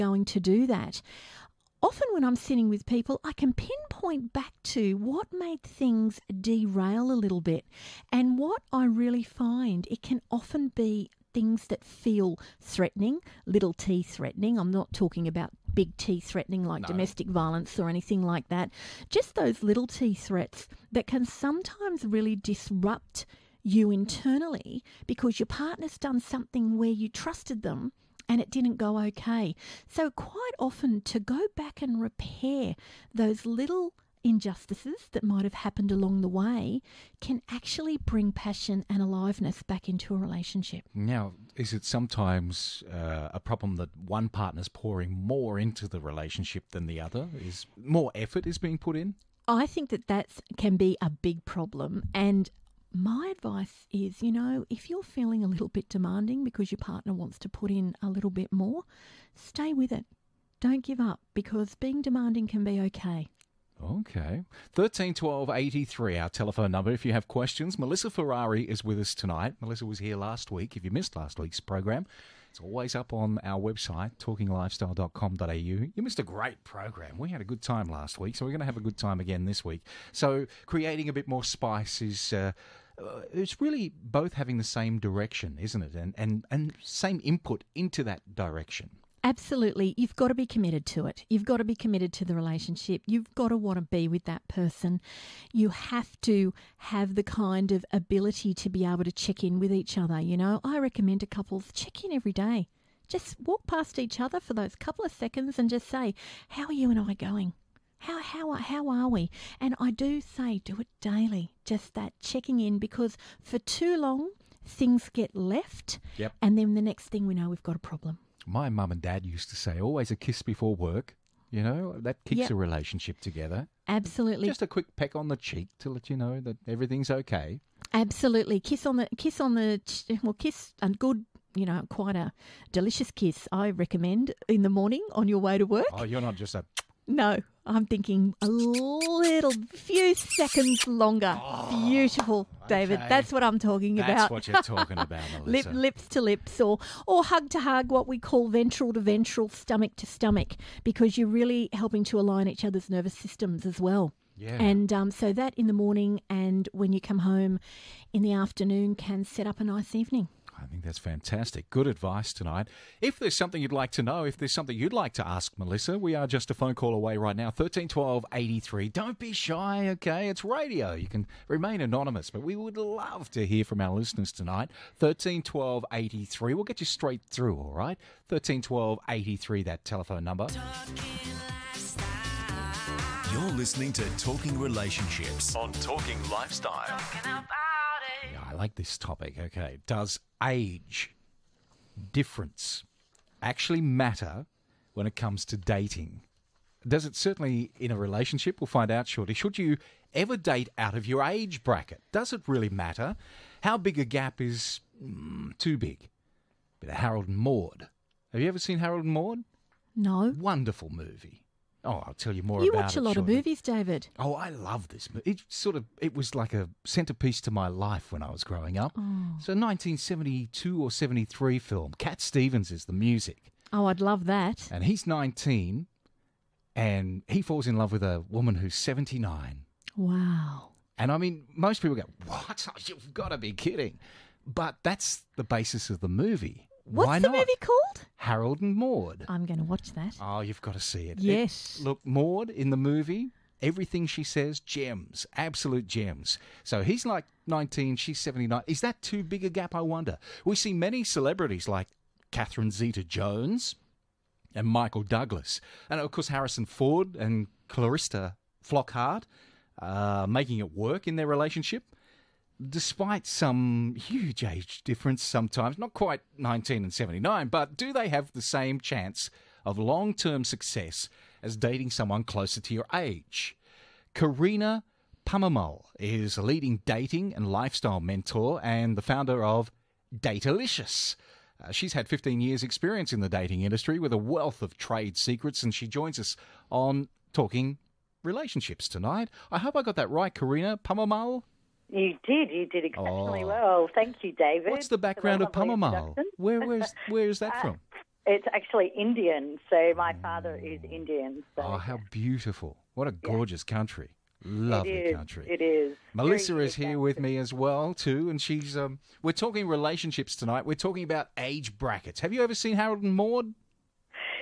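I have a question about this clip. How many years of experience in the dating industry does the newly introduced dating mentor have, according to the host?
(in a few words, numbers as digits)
15.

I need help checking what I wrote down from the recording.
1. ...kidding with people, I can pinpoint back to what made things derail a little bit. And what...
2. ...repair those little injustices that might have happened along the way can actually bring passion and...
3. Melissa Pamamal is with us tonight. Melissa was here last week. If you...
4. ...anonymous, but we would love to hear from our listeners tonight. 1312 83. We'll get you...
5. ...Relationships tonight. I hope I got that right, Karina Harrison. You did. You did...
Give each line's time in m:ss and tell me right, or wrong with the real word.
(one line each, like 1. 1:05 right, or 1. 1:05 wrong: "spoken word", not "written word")
1. 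0:02 wrong: "sitting", not "kidding"
2. 0:32 right
3. 1:07 wrong: "Ferrari", not "Pamamal"
4. 2:51 right
5. 4:48 wrong: "Pamamal", not "Harrison".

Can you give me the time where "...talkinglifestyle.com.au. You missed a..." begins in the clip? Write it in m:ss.
1:14.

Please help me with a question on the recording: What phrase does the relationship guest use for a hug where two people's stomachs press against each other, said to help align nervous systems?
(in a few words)
ventral to ventral.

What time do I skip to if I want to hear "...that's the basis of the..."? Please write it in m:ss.
3:54.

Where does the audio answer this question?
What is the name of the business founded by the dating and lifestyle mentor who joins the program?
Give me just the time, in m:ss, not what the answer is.
4:40.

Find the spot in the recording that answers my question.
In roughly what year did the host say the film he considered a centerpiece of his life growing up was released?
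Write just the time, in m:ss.
3:39.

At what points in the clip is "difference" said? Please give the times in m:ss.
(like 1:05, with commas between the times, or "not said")
3:12, 4:24.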